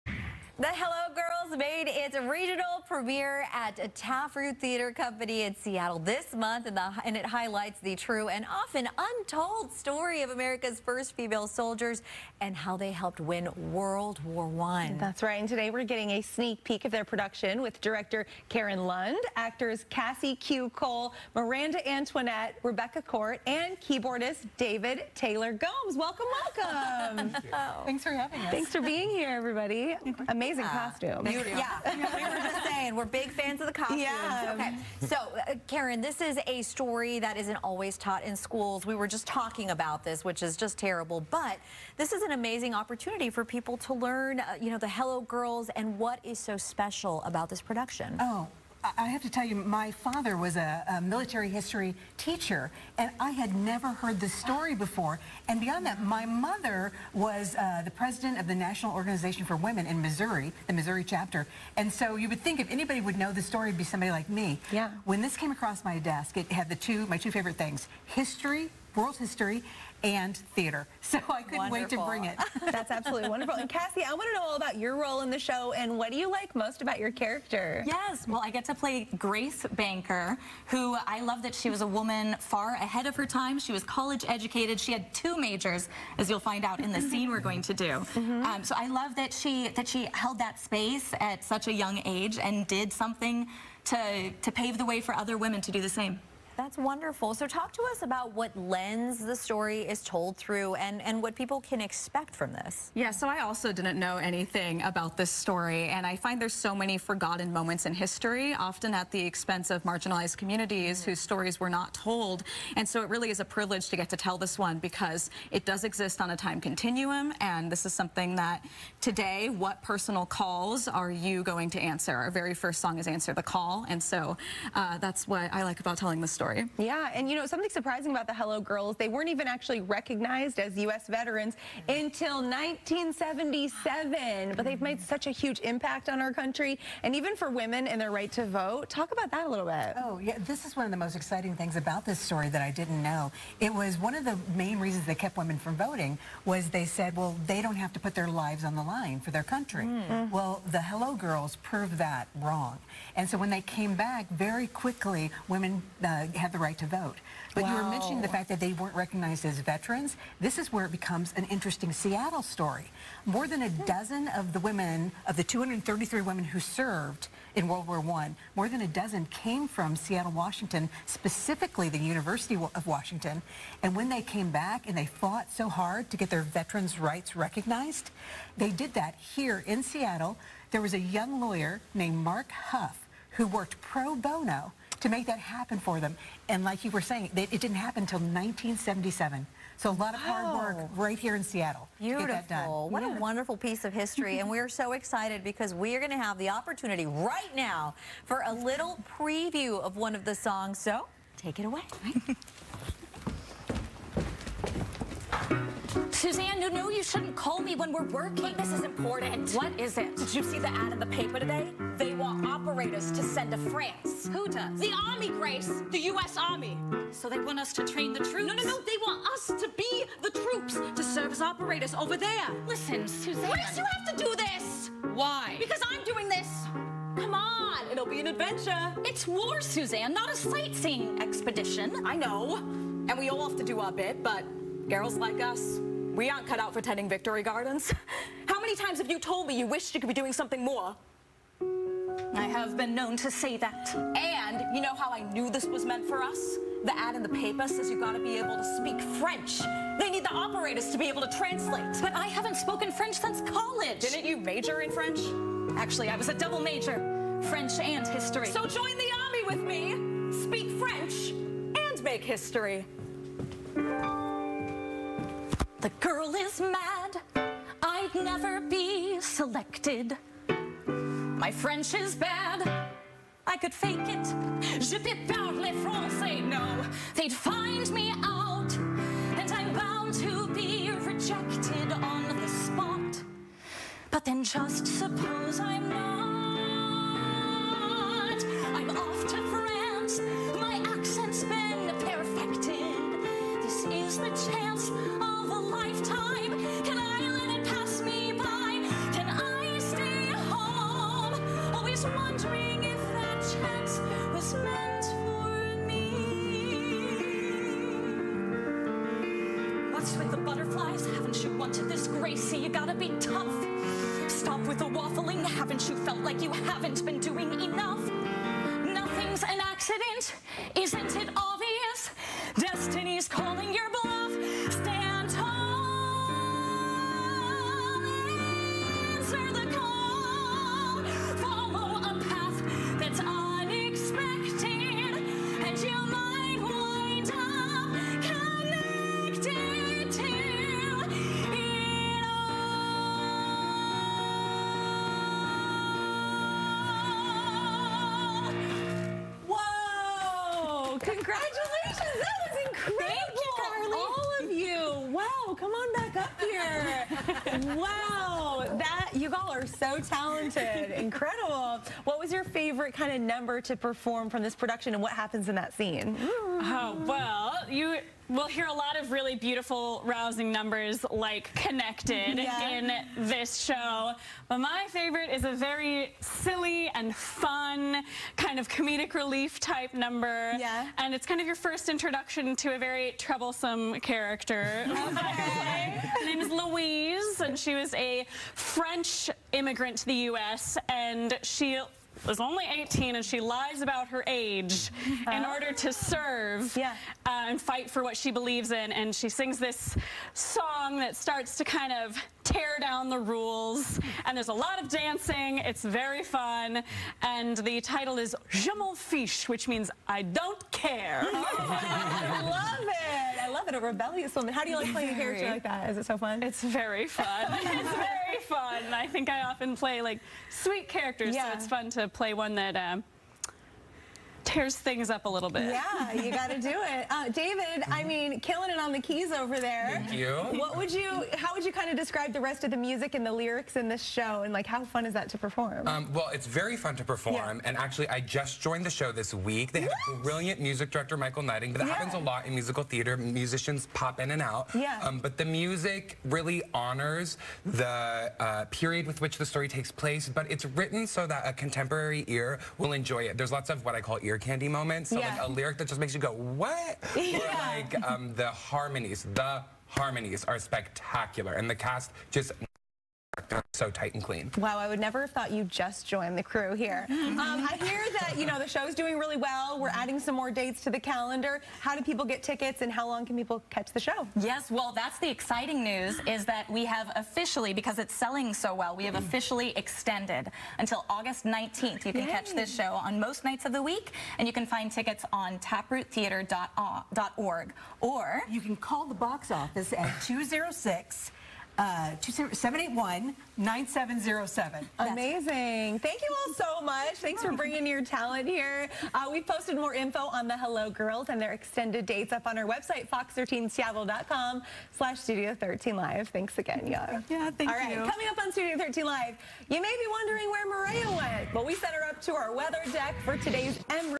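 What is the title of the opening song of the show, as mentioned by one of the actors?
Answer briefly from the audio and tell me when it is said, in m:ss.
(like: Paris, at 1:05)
Answer the Call, at 2:03.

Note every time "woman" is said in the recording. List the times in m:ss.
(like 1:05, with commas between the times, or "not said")
1:21, 6:54.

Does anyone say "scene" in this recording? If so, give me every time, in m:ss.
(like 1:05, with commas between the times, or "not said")
1:27, 6:05.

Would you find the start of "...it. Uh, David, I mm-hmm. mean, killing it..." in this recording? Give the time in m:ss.
7:06.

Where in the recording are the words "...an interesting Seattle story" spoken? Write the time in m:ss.
2:41.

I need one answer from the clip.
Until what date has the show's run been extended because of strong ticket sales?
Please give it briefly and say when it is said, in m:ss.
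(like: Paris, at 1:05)
August 19th, at 8:01.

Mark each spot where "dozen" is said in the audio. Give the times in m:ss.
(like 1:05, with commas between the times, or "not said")
2:43, 2:48.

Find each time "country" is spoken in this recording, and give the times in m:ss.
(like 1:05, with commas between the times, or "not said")
2:16, 2:29.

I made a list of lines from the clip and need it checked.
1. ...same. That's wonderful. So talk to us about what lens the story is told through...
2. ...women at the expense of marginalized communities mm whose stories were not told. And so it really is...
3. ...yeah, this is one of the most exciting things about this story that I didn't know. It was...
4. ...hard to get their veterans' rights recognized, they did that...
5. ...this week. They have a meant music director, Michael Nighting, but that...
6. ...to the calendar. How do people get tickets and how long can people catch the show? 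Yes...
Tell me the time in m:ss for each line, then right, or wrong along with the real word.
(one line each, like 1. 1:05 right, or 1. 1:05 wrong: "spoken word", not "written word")
1. 1:35 right
2. 1:48 wrong: "often", not "women"
3. 2:20 right
4. 2:55 right
5. 7:19 wrong: "brilliant", not "meant"
6. 7:50 right.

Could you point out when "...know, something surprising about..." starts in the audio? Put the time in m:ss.
2:07.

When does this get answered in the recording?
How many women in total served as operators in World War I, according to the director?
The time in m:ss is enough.
2:45.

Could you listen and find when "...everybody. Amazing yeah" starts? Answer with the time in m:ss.
0:29.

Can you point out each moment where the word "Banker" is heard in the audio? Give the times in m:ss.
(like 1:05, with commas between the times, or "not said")
1:19.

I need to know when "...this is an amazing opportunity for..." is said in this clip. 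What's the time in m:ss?
0:41.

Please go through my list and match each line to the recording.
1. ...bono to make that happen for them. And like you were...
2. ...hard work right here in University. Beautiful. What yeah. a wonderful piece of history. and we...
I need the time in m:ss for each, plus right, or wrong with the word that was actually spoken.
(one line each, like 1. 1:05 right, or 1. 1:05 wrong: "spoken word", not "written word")
1. 3:04 right
2. 3:10 wrong: "Seattle", not "University".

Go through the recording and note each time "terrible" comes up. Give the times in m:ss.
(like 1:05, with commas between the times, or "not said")
0:40.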